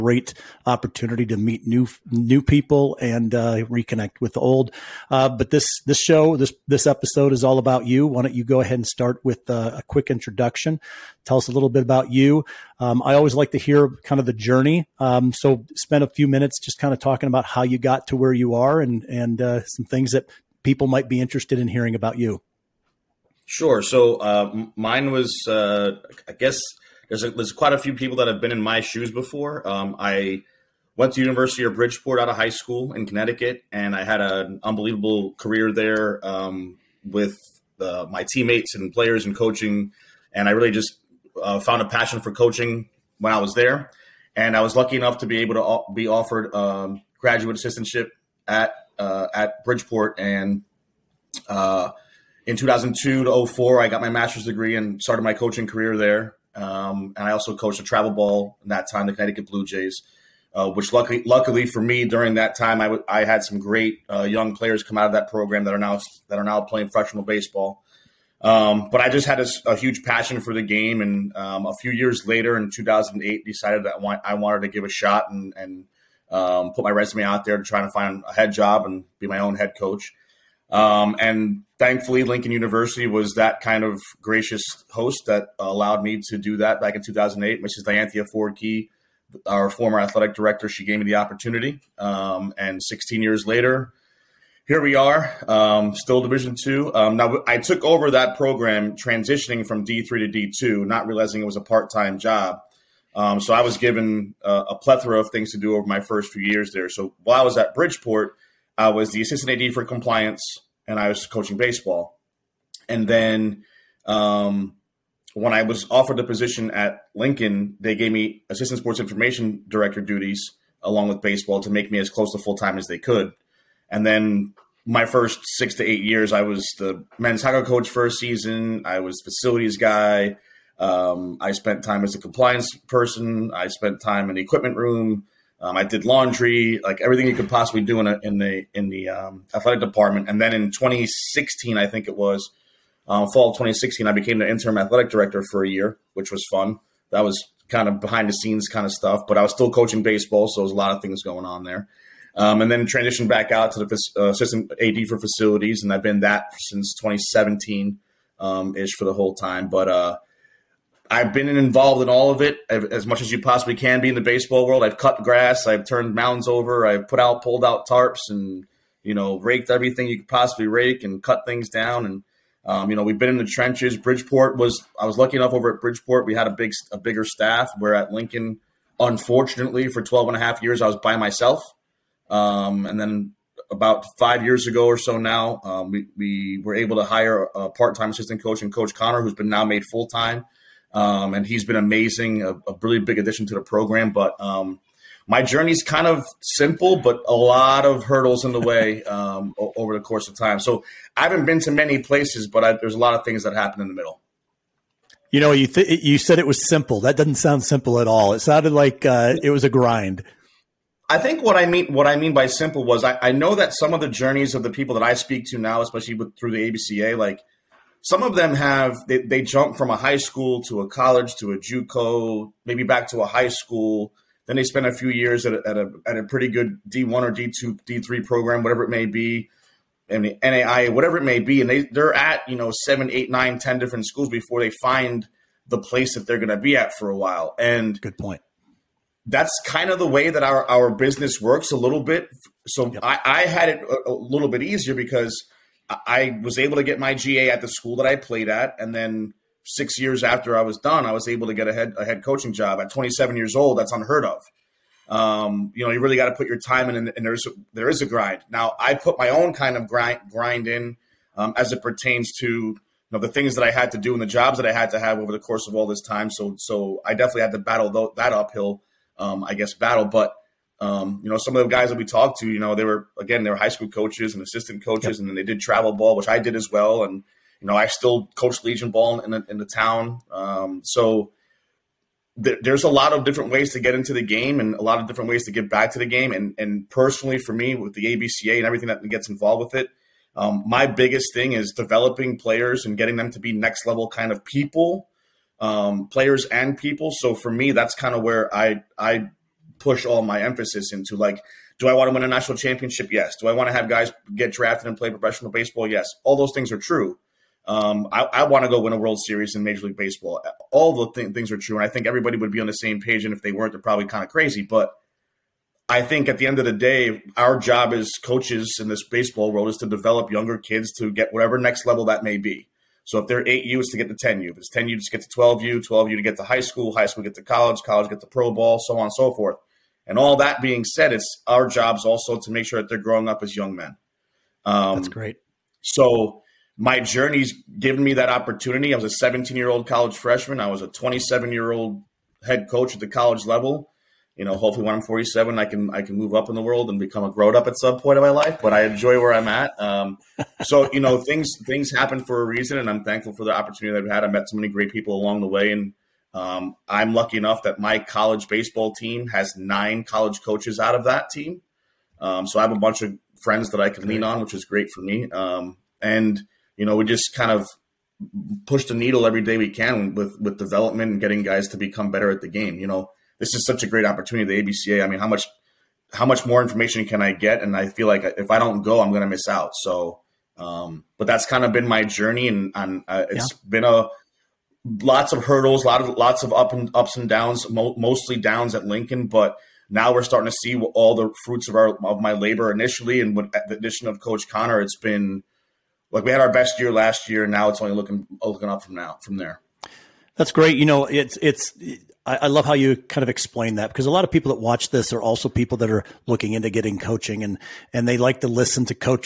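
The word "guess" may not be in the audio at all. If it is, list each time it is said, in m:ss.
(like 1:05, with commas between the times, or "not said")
0:26, 4:29.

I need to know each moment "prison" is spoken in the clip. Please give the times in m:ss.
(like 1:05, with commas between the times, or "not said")
not said.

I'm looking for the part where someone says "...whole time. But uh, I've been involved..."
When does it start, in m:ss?
2:39.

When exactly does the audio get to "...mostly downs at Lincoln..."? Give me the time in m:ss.
6:27.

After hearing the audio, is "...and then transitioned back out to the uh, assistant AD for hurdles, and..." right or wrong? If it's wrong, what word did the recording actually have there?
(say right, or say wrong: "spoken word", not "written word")
wrong: "facilities", not "hurdles".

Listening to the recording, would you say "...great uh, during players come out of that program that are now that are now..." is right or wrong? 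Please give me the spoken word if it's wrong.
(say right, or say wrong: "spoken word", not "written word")
wrong: "young", not "during".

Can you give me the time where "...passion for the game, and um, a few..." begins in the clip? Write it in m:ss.
1:10.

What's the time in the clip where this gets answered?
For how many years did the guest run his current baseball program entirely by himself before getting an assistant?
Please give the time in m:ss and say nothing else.
3:00.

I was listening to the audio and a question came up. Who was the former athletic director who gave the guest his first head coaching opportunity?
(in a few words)
Dianthia Ford-Kee.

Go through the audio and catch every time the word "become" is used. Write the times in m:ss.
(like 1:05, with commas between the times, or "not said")
5:46, 6:11.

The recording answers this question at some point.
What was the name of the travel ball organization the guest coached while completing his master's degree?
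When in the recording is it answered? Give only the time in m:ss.
0:59.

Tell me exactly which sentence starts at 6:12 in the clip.
You know, this is such a great opportunity, the ABCA.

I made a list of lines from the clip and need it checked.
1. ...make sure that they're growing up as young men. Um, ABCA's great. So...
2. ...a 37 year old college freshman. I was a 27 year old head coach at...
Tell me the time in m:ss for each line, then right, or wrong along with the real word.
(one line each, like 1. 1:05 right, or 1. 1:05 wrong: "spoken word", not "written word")
1. 5:32 wrong: "That", not "ABCA"
2. 5:39 wrong: "17", not "37".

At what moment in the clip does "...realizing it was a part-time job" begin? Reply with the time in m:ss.
1:41.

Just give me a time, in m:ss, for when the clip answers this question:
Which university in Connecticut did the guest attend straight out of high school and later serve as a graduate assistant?
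0:31.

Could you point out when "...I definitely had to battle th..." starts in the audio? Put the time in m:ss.
4:27.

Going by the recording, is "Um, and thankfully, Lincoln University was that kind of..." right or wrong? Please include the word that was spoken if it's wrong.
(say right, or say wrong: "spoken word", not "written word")
right.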